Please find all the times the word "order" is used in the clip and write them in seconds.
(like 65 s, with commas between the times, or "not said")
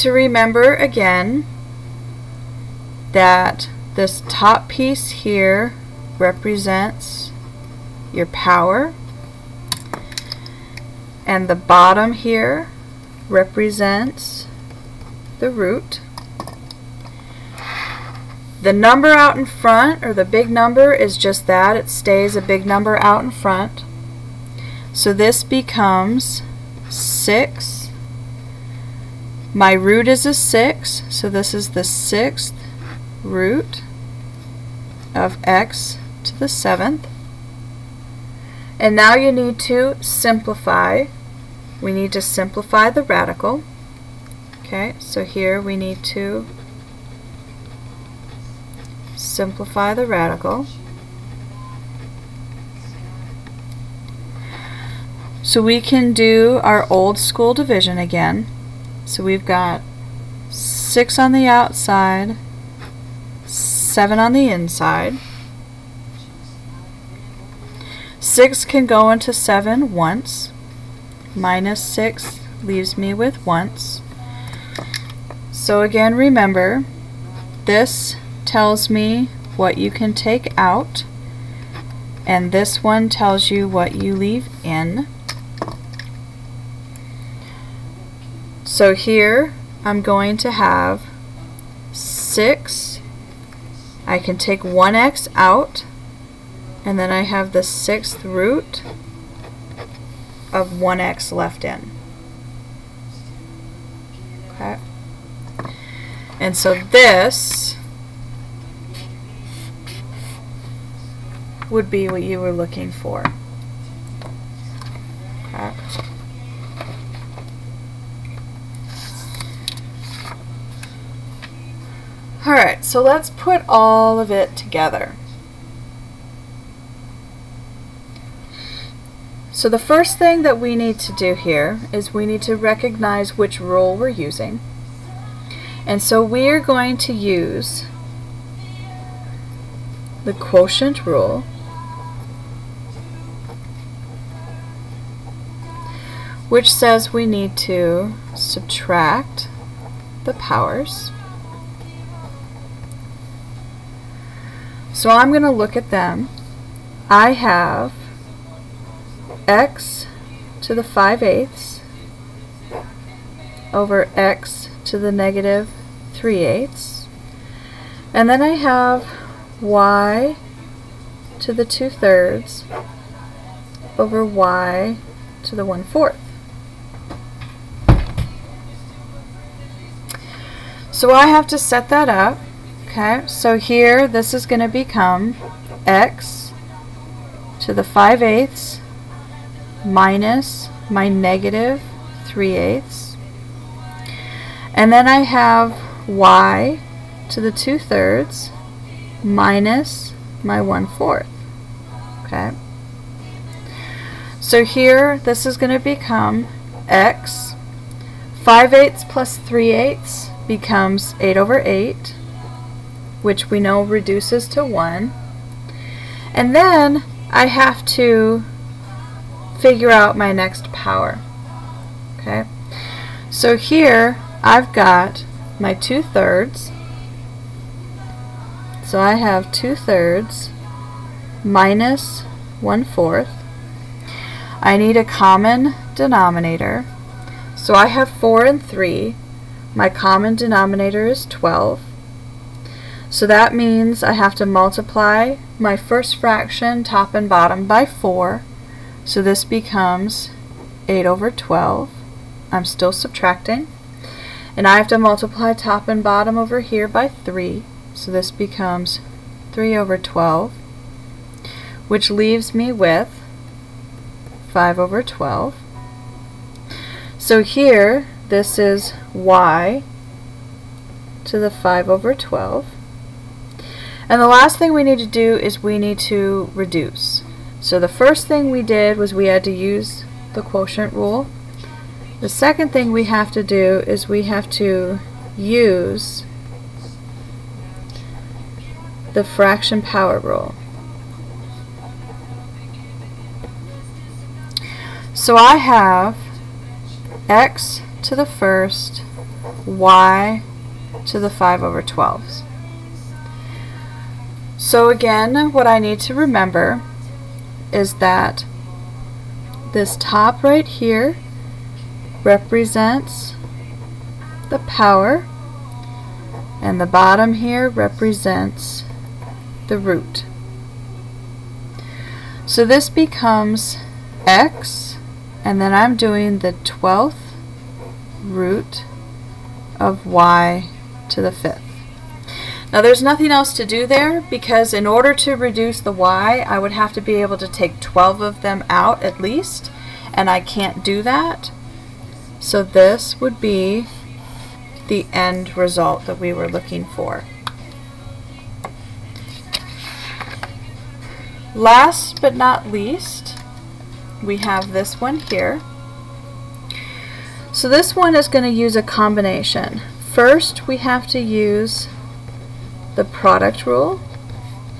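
334 s.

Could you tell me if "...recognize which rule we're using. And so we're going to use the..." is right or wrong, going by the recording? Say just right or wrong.
right.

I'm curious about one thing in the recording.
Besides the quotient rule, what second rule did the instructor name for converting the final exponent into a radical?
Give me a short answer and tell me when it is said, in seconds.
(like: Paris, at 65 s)
fraction power rule, at 289 s.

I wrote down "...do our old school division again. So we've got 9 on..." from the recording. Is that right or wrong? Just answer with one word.
wrong.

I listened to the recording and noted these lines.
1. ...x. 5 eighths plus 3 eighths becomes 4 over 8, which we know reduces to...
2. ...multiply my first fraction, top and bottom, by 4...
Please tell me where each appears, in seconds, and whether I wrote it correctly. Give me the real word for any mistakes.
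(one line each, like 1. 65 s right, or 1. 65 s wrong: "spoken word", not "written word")
1. 206 s wrong: "8", not "4"
2. 244 s right.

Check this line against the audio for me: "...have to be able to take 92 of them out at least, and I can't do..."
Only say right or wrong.
wrong.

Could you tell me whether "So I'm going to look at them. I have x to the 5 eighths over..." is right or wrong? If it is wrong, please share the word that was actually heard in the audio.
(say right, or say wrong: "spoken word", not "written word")
right.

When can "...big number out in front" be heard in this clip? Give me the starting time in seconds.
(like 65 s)
22 s.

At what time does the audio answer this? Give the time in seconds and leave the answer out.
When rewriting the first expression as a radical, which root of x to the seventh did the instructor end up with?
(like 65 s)
31 s.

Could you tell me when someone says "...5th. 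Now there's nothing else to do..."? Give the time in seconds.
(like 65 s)
331 s.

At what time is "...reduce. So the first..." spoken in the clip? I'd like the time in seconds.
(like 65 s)
276 s.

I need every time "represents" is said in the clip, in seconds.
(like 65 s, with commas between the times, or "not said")
6 s, 13 s, 312 s, 317 s.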